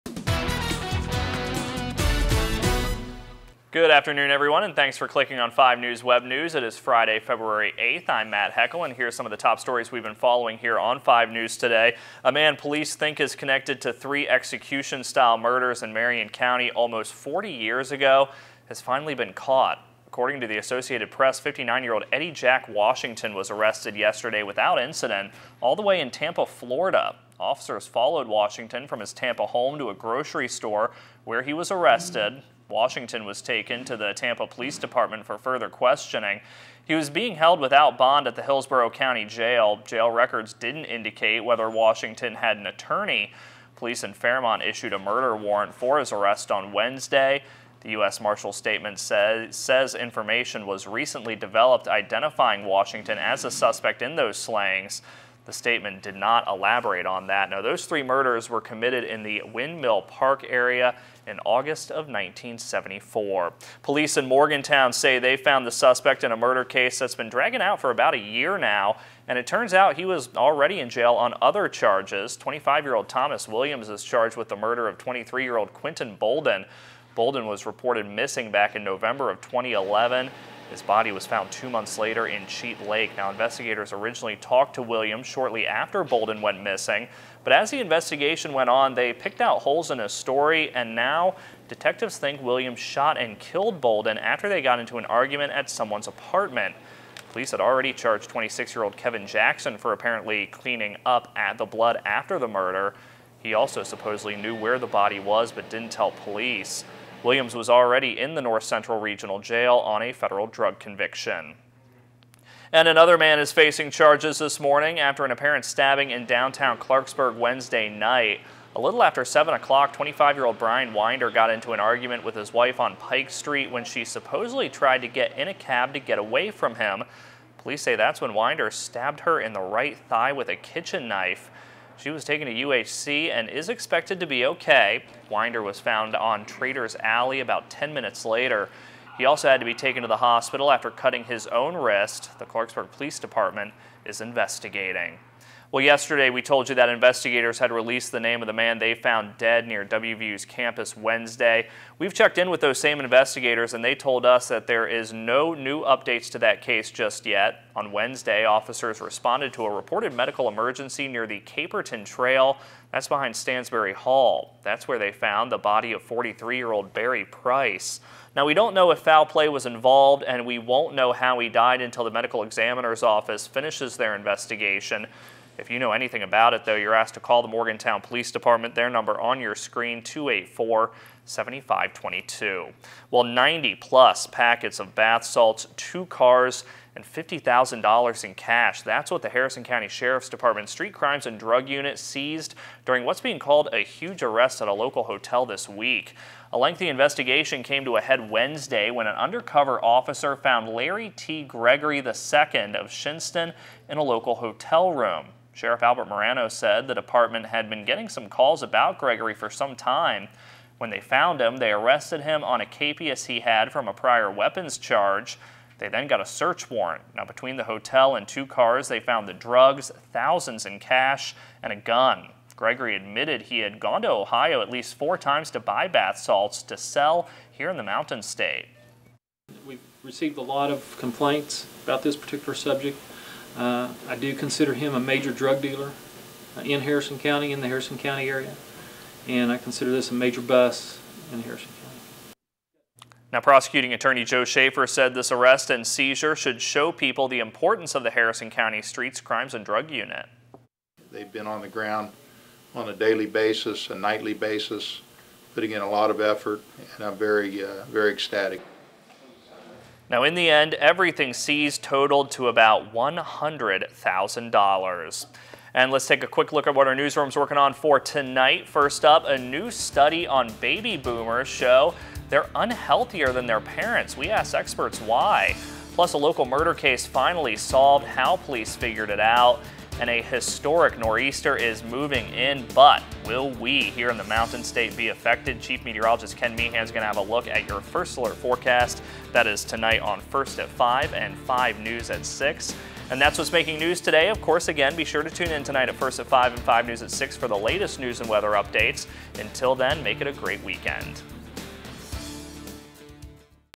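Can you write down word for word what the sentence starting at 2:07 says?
Police say that's when Winder stabbed her in the right thigh with a kitchen knife.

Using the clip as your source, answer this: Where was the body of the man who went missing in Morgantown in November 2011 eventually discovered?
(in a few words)
Cheat Lake.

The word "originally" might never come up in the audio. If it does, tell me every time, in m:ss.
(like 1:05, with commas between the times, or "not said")
1:23.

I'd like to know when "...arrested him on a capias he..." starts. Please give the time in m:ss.
3:31.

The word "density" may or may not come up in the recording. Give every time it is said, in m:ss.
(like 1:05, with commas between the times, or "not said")
not said.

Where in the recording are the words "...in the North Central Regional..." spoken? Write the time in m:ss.
1:48.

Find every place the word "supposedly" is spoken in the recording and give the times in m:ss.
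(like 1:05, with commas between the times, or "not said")
1:43, 2:04.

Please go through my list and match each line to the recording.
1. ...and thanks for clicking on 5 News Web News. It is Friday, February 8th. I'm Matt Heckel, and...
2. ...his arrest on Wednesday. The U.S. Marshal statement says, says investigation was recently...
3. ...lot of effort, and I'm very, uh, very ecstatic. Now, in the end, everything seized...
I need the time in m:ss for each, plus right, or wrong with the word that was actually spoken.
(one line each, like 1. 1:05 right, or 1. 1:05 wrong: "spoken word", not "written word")
1. 0:04 right
2. 0:45 wrong: "information", not "investigation"
3. 4:15 right.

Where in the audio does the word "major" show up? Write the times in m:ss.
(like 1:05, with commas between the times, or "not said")
3:54, 4:00.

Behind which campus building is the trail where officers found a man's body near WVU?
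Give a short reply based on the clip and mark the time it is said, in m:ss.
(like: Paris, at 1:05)
Stansbury Hall, at 2:43.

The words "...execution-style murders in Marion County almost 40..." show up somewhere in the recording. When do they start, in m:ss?
0:14.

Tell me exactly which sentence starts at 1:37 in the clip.
Police had already charged 26-year-old Kevin Jackson for apparently cleaning up at the blood after the murder.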